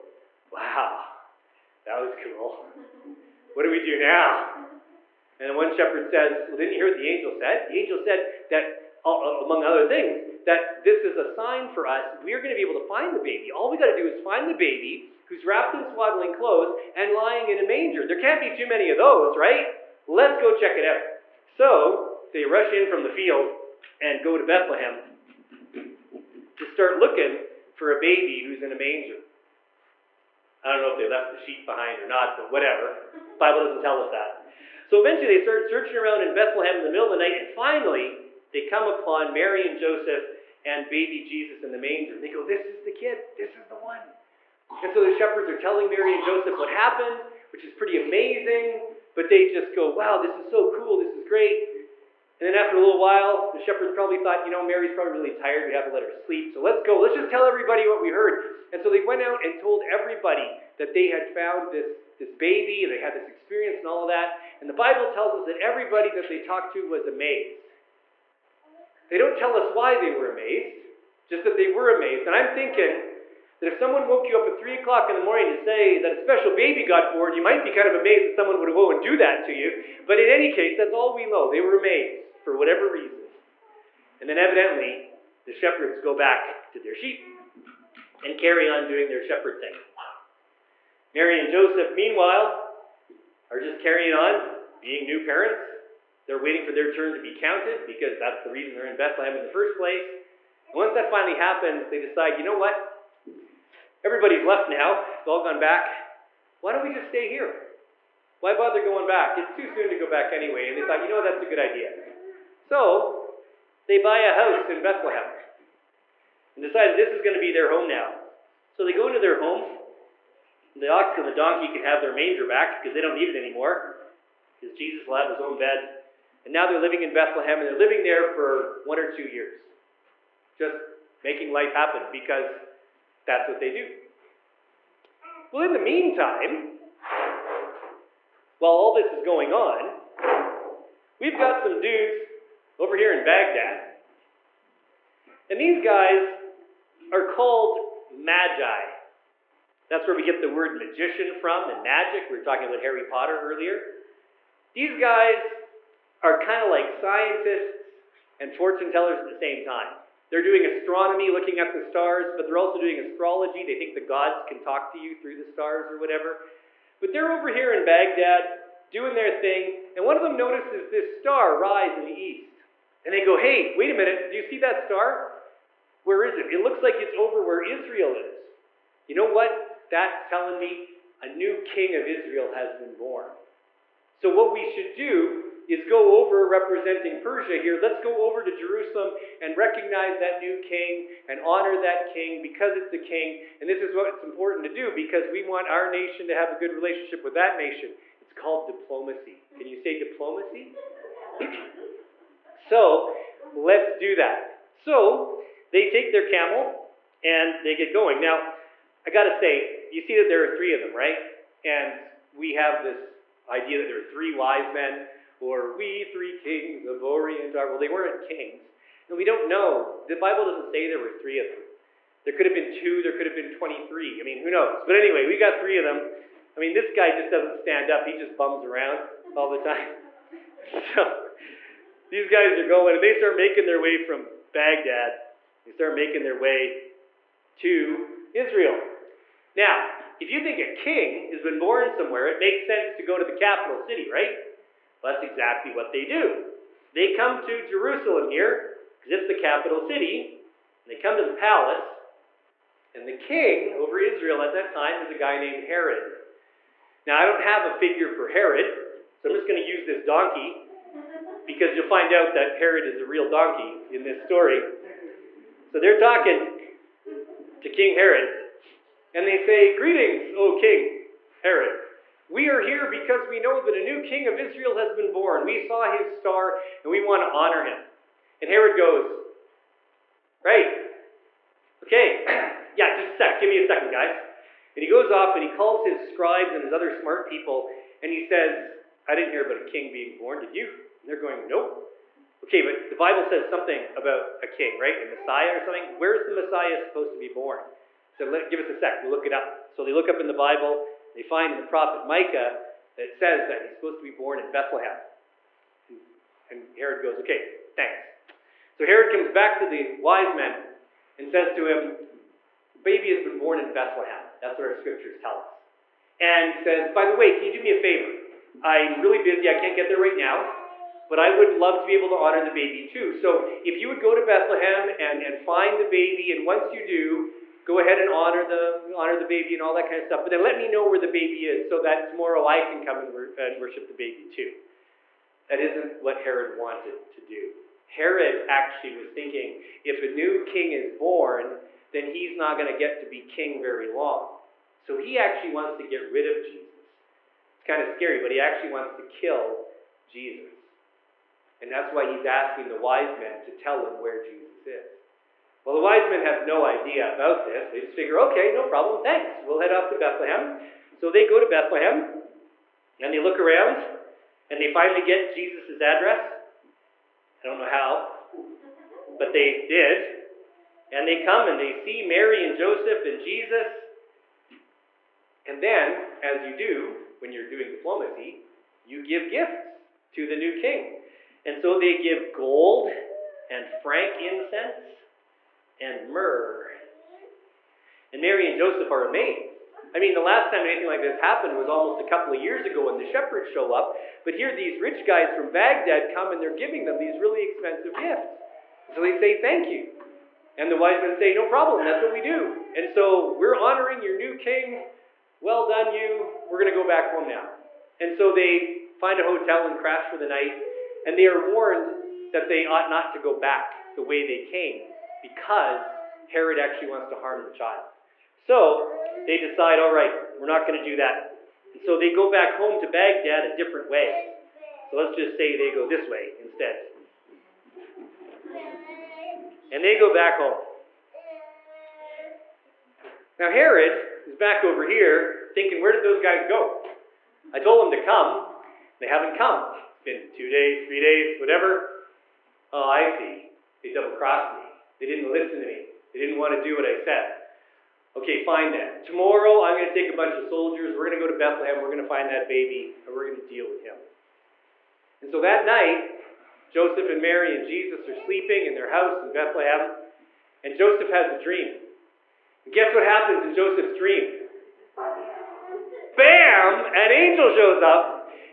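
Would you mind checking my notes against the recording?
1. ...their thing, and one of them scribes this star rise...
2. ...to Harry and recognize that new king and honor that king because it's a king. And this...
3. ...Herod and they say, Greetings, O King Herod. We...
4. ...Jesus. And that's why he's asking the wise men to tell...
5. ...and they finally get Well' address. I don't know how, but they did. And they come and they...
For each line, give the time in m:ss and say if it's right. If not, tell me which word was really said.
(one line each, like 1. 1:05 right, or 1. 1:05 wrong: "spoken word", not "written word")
1. 2:49 wrong: "notices", not "scribes"
2. 3:08 wrong: "Jerusalem", not "Harry"
3. 4:27 right
4. 5:50 right
5. 6:04 wrong: "Jesus", not "Well".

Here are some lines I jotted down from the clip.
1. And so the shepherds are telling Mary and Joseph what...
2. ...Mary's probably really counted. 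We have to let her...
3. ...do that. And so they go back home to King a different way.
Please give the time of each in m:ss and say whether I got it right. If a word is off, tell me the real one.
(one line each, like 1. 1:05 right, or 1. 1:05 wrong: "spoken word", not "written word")
1. 0:44 right
2. 0:54 wrong: "tired", not "counted"
3. 7:00 wrong: "Baghdad", not "King".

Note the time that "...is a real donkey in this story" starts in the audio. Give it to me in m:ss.
4:22.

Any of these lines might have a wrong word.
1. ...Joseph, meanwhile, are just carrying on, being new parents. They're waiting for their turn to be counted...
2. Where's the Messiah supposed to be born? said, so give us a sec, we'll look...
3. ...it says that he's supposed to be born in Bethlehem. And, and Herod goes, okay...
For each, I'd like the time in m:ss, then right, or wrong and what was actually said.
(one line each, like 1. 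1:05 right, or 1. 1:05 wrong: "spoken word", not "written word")
1. 1:31 right
2. 4:55 right
3. 5:03 right.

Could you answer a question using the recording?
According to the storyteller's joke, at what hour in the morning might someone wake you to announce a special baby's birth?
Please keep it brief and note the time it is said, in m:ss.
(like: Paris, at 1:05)
3 o'clock, at 1:14.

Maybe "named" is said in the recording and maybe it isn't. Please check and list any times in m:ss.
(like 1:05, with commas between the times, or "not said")
4:15.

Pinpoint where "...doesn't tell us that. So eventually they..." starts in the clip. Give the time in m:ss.
0:33.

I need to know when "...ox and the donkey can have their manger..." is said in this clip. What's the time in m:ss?
2:00.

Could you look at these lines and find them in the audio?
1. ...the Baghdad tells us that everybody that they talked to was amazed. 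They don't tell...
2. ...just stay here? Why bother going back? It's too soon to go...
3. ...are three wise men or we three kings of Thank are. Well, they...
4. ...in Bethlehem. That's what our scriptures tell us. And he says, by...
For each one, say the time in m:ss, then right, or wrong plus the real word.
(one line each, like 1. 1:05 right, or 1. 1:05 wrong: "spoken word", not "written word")
1. 1:04 wrong: "Bible", not "Baghdad"
2. 1:46 right
3. 3:33 wrong: "Orient", not "Thank"
4. 5:13 right.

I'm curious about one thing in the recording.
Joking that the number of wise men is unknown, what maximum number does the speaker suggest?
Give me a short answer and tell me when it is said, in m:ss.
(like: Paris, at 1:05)
23, at 3:43.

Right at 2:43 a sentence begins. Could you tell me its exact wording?
They think the gods can talk to you through the stars or whatever.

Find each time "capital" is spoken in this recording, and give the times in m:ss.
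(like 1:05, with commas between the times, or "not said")
4:03, 4:09.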